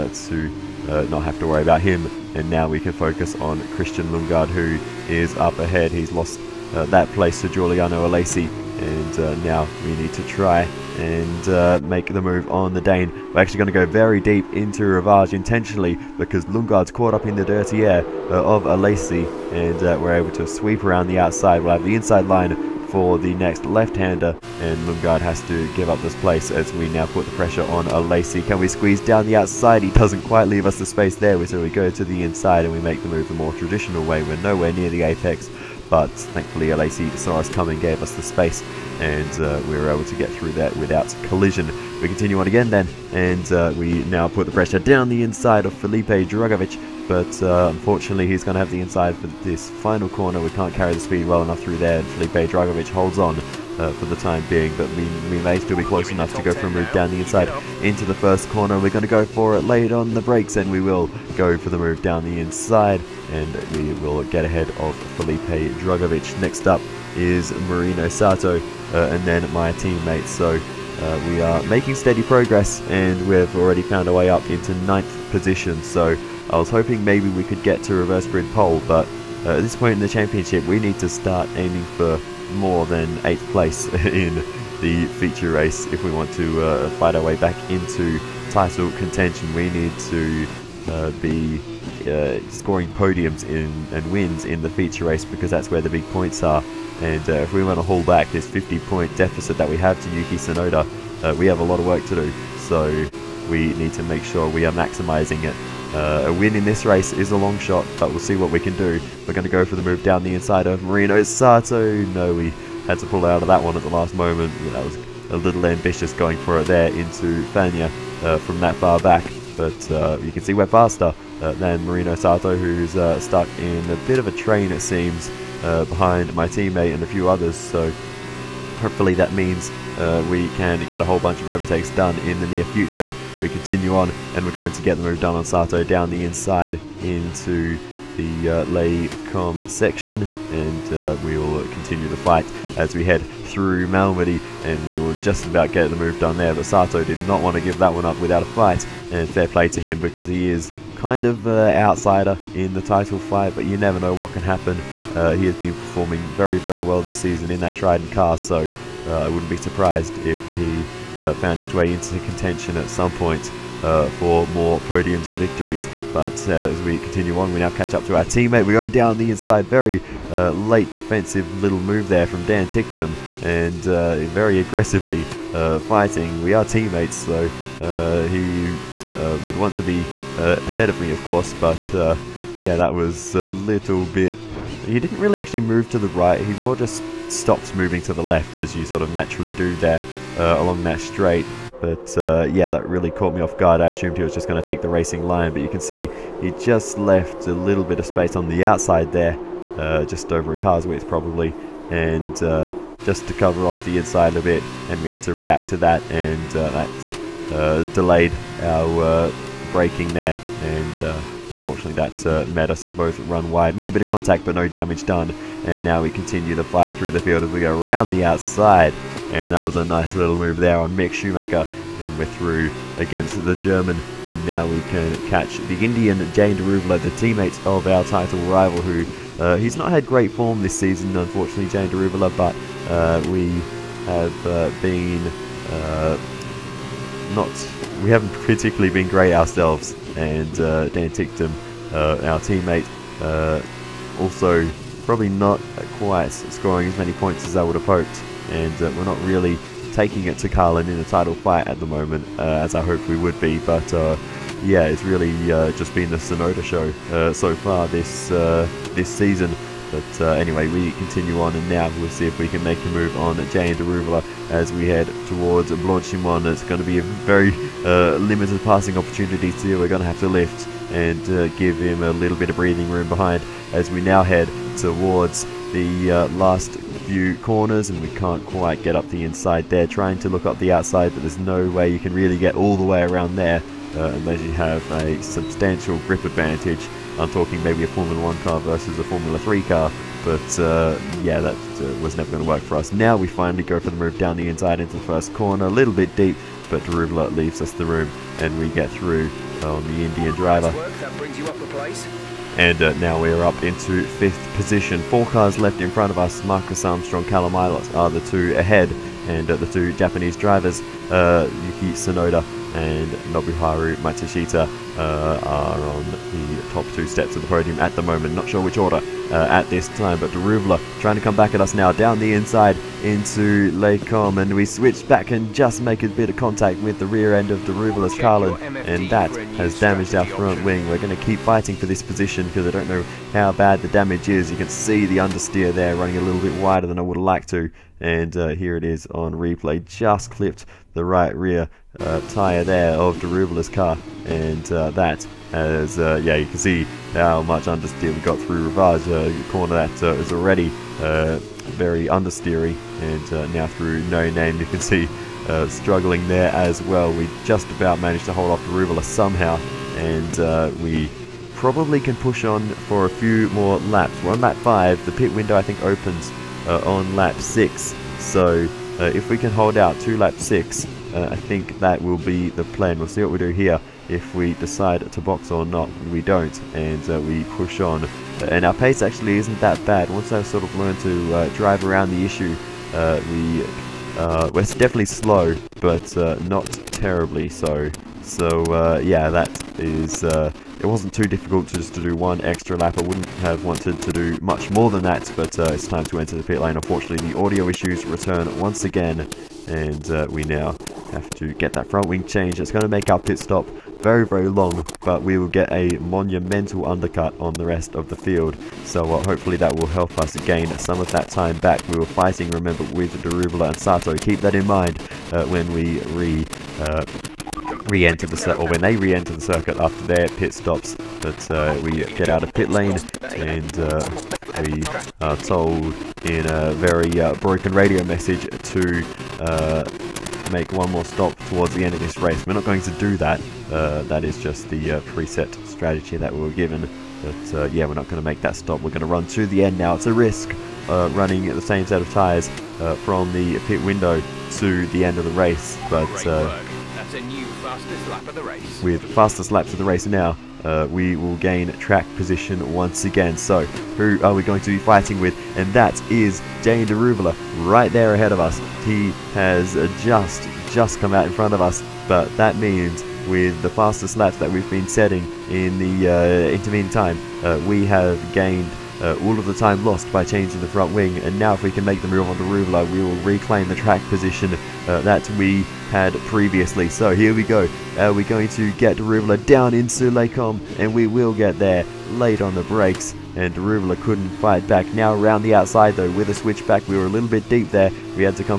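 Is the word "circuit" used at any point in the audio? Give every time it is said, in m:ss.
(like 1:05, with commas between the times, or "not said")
6:59.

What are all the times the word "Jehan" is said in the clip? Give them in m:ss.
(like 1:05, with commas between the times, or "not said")
3:46, 3:51, 4:23.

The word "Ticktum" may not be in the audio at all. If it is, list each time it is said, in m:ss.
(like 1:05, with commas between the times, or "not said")
2:52, 4:01.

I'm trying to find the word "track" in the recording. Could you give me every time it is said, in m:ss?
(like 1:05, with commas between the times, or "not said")
7:31, 7:53.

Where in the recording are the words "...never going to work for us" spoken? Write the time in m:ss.
4:52.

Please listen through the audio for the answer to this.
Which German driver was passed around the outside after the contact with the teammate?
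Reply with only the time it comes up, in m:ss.
3:40.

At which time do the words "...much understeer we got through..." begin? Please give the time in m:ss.
5:47.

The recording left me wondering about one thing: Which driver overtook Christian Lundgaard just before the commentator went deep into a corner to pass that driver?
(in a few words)
Giuliano Alesi.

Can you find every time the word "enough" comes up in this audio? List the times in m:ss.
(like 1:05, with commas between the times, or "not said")
0:51, 0:56.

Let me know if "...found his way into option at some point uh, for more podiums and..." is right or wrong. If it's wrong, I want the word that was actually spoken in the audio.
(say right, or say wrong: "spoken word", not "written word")
wrong: "contention", not "option".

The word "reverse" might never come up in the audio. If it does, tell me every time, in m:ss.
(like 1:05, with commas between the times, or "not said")
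1:17.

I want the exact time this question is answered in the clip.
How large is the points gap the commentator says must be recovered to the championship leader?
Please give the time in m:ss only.
1:38.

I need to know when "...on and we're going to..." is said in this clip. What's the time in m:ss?
2:13.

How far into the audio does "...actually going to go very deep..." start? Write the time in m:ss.
0:13.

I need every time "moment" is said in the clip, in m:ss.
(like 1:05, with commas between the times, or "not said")
1:54, 4:11, 5:18.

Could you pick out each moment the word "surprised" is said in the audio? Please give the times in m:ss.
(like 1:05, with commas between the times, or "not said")
2:39.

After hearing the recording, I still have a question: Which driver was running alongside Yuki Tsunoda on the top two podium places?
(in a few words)
Nobuharu Matsushita.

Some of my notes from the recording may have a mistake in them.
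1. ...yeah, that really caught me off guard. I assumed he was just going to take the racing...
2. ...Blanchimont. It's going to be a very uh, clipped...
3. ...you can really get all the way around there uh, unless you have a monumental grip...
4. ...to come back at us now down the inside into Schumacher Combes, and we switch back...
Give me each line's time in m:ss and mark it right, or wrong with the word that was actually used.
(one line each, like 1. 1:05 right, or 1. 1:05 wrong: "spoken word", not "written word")
1. 3:12 right
2. 4:25 wrong: "limited", not "clipped"
3. 4:41 wrong: "substantial", not "monumental"
4. 5:21 wrong: "Les", not "Schumacher".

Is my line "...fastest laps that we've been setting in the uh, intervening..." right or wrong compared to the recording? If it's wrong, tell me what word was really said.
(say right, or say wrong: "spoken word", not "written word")
right.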